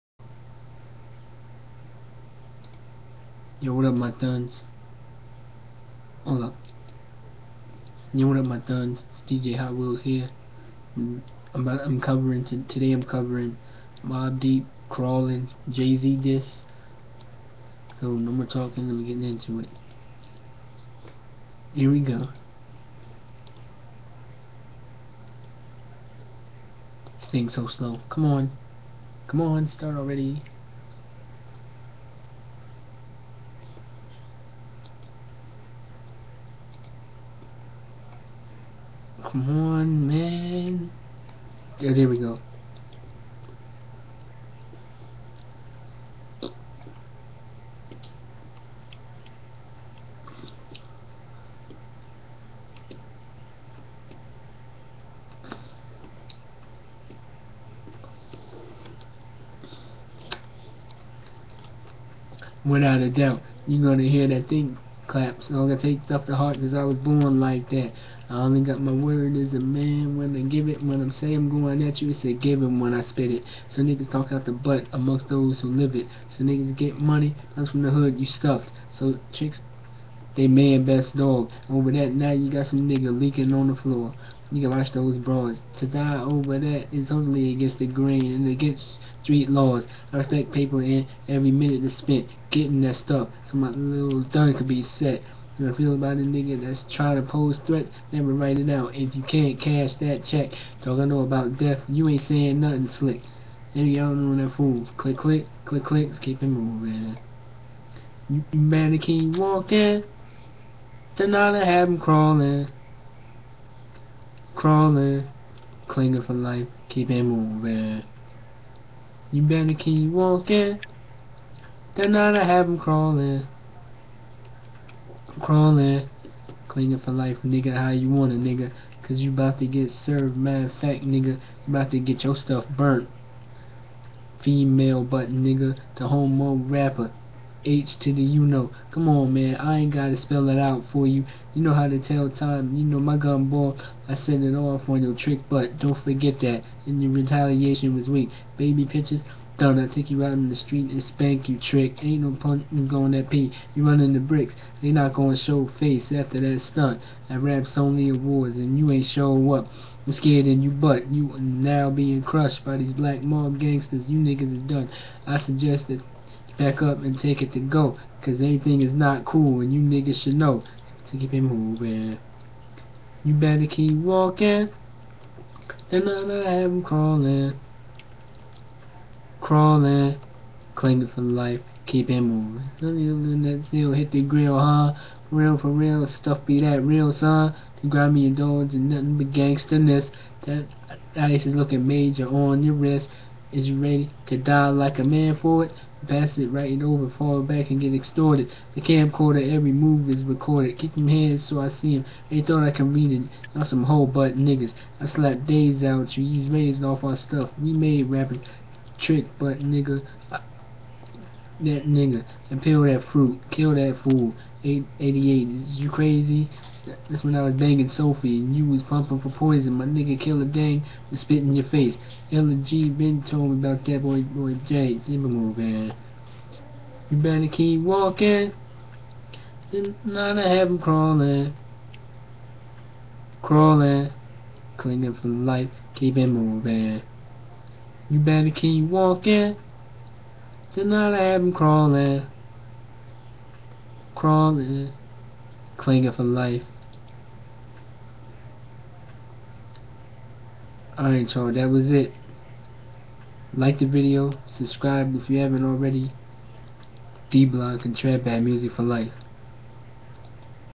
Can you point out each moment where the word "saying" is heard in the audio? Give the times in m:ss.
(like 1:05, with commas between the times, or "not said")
1:11, 1:42.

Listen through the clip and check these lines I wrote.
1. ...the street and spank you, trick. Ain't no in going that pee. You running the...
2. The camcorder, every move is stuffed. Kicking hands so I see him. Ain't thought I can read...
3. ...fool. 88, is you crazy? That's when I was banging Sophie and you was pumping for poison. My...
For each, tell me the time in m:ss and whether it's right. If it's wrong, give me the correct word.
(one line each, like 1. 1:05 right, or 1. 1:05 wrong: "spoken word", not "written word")
1. 2:30 right
2. 3:18 wrong: "recorded", not "stuffed"
3. 3:34 right.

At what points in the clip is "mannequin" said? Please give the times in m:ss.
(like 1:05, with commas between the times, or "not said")
1:48.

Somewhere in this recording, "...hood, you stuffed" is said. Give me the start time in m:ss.
1:17.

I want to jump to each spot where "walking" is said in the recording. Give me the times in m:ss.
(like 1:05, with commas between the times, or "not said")
1:49, 2:00, 2:53, 3:47, 3:58.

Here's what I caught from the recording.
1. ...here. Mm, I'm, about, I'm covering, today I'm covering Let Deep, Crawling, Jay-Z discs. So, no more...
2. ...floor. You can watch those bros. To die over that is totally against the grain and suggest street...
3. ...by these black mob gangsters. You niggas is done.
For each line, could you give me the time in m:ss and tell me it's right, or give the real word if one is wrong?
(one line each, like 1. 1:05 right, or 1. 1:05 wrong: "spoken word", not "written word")
1. 0:10 wrong: "Mobb", not "Let"
2. 1:23 wrong: "against", not "suggest"
3. 2:42 right.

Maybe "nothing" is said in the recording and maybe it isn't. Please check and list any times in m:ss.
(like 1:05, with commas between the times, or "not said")
1:42, 3:08.